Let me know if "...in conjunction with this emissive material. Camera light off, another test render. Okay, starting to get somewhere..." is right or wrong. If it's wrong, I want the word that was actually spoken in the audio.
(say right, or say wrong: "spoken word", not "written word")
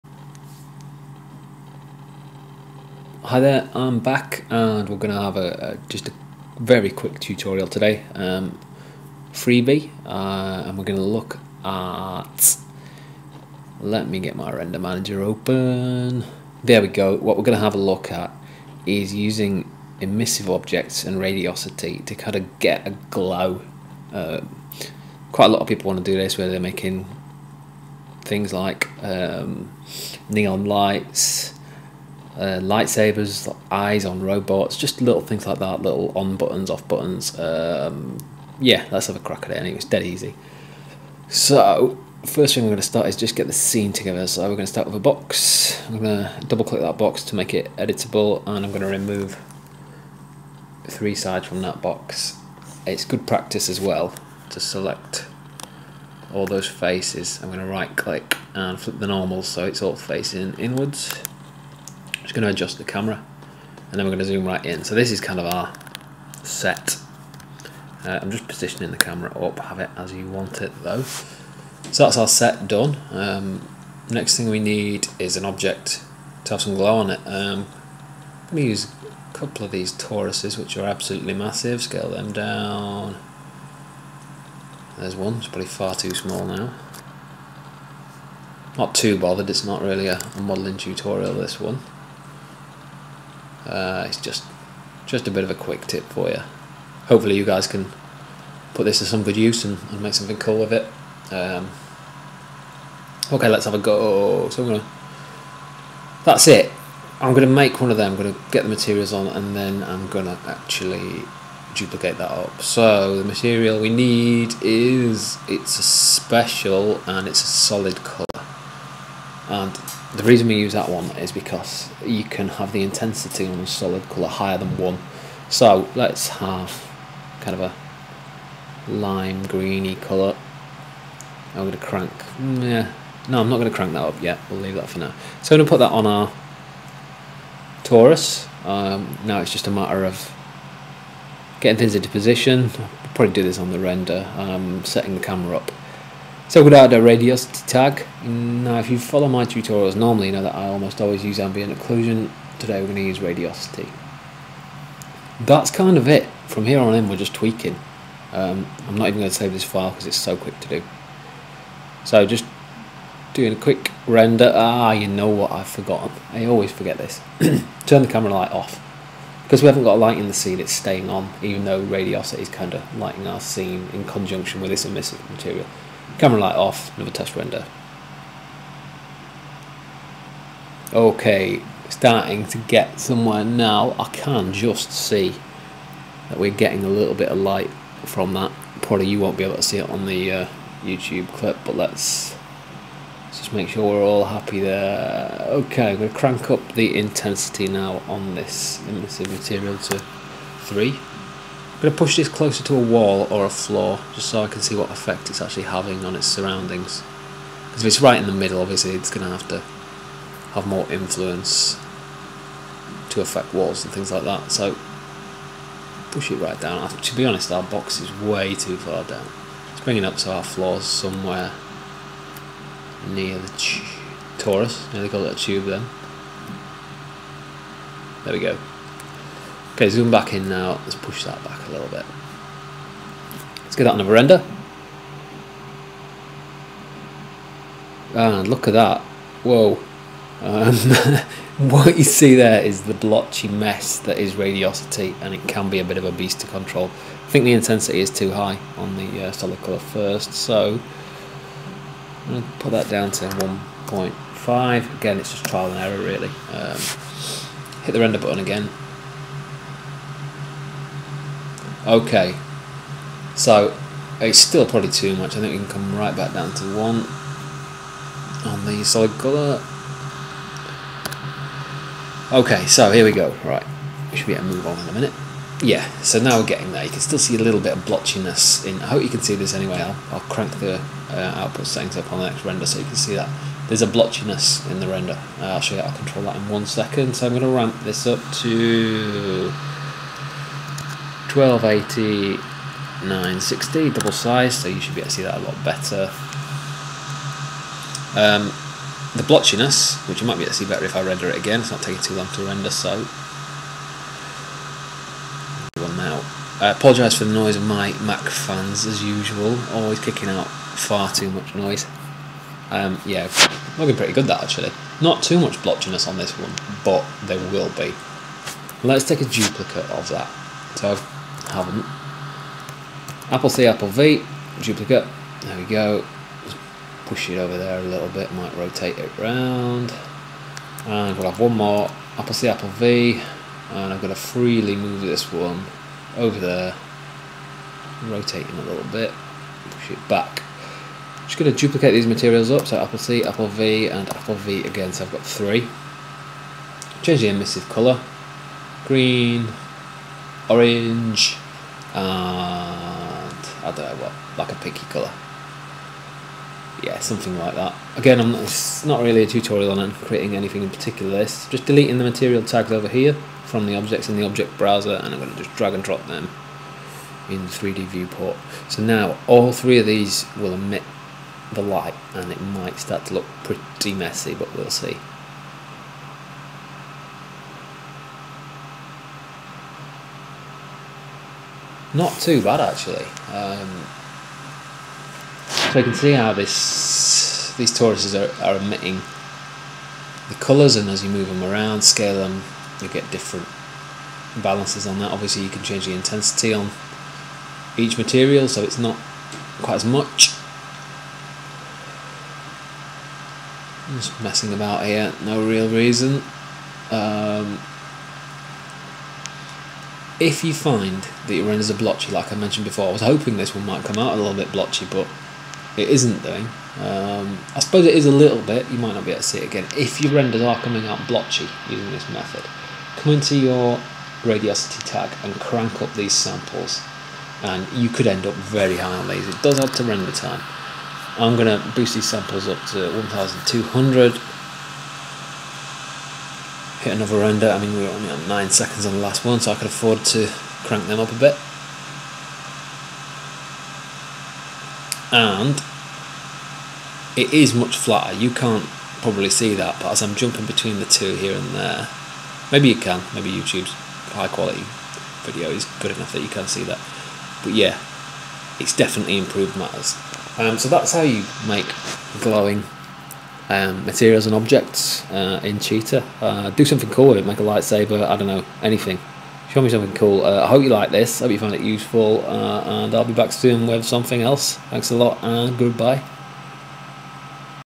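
right.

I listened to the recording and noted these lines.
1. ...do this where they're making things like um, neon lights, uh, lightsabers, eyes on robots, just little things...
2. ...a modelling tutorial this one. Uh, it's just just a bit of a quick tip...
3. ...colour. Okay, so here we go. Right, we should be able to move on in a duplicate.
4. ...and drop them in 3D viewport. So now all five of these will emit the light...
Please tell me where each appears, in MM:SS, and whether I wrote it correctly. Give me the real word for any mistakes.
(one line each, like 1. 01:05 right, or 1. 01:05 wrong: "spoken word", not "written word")
1. 00:26 right
2. 01:30 right
3. 04:29 wrong: "minute", not "duplicate"
4. 06:05 wrong: "three", not "five".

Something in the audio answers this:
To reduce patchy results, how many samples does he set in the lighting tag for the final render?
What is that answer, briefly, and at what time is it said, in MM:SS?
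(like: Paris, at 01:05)
1200, at 07:13.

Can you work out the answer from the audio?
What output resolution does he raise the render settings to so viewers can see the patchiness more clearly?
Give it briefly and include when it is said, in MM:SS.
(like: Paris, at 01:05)
1280 x 960, at 04:51.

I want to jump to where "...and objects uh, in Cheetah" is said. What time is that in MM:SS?
07:44.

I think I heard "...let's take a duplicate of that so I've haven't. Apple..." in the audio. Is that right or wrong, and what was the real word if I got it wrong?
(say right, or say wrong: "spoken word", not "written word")
right.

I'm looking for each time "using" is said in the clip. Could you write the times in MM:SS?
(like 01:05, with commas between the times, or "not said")
00:19, 07:01.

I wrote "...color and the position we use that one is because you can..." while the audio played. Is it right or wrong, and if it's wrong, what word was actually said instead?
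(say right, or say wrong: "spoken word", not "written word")
wrong: "reason", not "position".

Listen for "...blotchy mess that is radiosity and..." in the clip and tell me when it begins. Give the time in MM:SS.
04:02.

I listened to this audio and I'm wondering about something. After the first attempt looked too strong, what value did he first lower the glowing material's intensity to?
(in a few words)
1.5.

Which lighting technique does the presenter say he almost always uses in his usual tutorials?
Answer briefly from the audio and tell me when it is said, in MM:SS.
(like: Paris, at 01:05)
ambient occlusion, at 02:31.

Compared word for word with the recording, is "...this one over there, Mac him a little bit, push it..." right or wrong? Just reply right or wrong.
wrong.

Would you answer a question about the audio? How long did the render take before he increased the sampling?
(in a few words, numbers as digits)
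9 seconds.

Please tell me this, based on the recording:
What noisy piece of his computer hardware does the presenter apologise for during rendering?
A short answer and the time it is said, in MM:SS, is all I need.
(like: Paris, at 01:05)
Mac fans, at 05:08.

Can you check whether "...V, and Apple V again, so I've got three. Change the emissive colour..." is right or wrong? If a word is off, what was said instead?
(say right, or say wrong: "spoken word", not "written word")
right.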